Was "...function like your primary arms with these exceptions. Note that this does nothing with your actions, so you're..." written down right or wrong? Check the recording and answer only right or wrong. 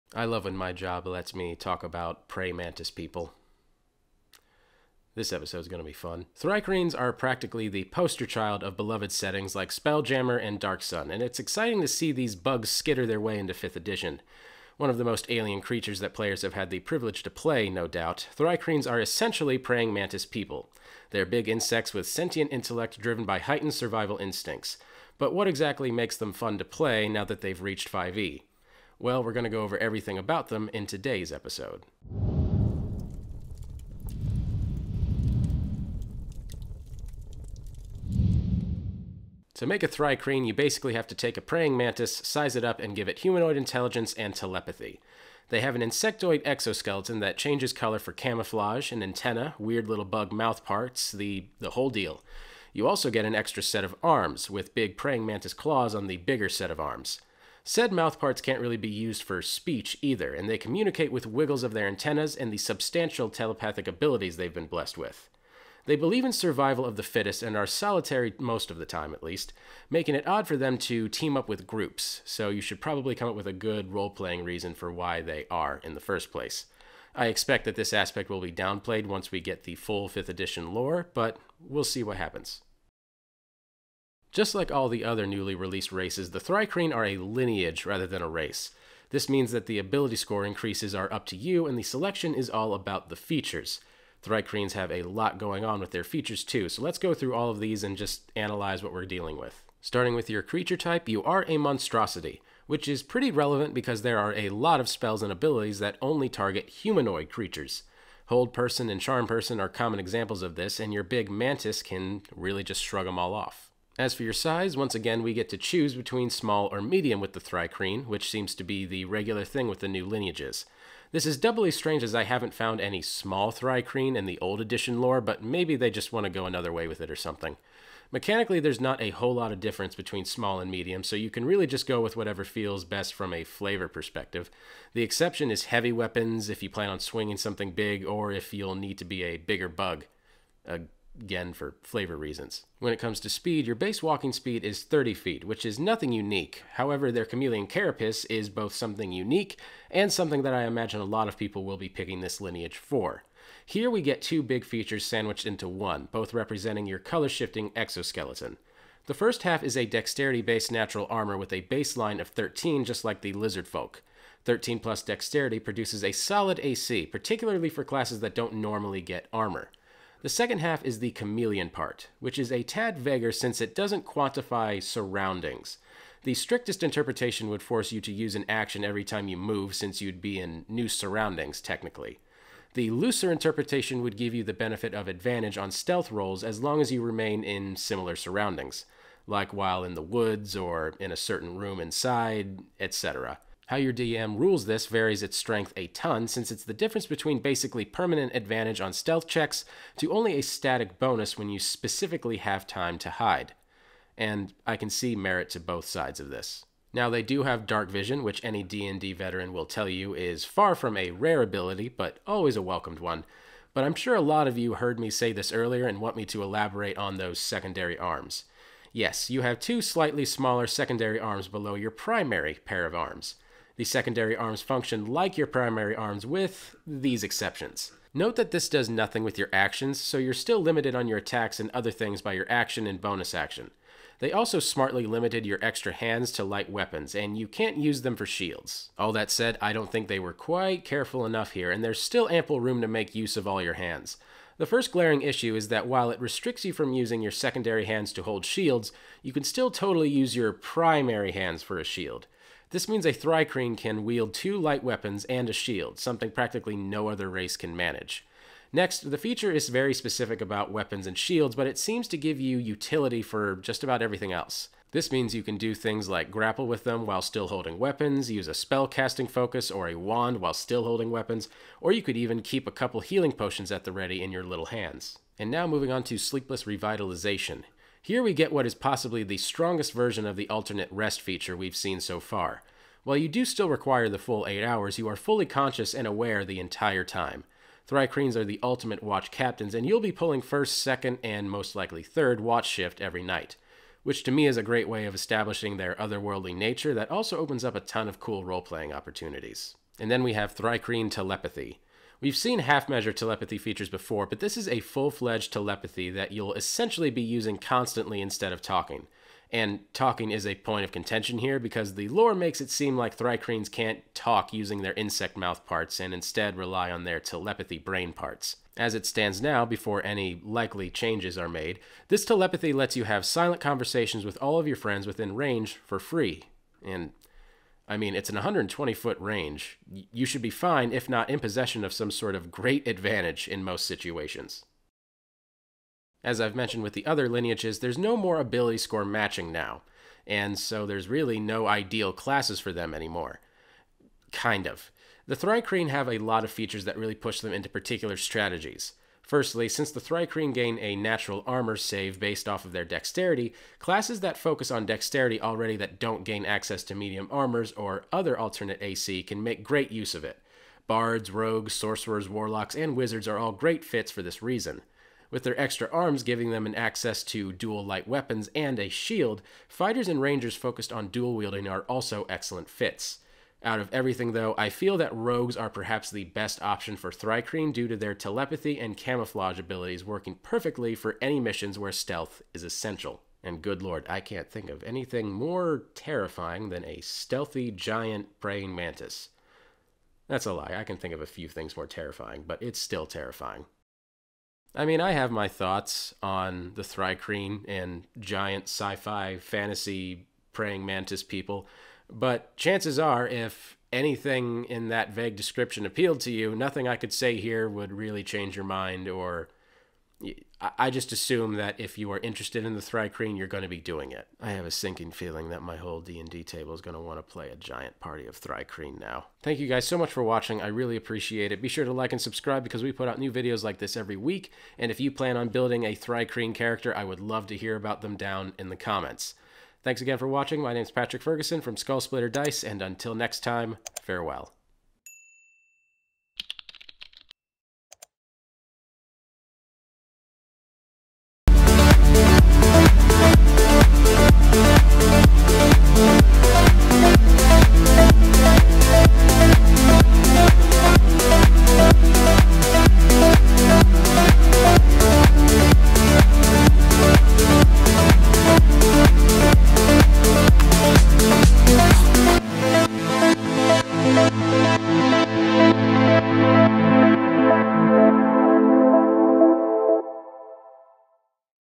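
right.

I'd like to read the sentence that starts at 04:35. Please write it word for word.
And now moving on to Sleepless Revitalization.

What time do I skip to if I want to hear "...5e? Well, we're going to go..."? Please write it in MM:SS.
00:27.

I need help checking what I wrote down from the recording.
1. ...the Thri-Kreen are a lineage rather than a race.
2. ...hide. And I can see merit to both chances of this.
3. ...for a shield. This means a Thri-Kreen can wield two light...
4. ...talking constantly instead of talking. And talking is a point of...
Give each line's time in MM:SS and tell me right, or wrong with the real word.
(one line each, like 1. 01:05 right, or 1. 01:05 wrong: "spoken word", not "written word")
1. 01:26 right
2. 03:23 wrong: "sides", not "chances"
3. 04:11 right
4. 05:07 wrong: "using", not "talking".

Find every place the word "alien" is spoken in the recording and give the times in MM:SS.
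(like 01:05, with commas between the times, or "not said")
00:15.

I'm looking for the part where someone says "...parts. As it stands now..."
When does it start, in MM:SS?
05:18.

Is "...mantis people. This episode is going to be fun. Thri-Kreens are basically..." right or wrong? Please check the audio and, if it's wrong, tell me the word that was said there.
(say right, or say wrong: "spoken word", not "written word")
wrong: "practically", not "basically".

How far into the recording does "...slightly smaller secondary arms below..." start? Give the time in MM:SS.
03:39.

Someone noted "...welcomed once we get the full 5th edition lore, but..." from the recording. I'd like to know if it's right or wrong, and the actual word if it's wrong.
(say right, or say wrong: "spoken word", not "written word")
wrong: "downplayed", not "welcomed".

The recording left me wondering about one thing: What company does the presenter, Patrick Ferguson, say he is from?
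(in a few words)
Skull Splitter Dice.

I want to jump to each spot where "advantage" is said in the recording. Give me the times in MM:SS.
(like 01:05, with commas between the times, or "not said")
03:05, 03:18, 05:32.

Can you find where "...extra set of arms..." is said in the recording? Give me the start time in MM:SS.
00:53.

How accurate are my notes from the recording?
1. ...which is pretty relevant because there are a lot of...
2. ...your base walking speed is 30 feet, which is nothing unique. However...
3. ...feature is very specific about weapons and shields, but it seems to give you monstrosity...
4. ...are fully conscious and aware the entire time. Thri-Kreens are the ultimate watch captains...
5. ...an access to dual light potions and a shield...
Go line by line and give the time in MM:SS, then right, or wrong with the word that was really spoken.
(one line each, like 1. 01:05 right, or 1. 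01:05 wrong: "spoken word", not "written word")
1. 01:42 right
2. 02:23 right
3. 04:19 wrong: "utility", not "monstrosity"
4. 04:45 right
5. 06:06 wrong: "weapons", not "potions".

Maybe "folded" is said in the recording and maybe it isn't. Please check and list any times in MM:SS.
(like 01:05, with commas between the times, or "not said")
not said.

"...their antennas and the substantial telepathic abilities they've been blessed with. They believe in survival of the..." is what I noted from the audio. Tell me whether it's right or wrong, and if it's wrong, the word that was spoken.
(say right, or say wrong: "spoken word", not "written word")
right.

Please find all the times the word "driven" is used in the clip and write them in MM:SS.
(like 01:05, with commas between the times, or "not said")
00:22.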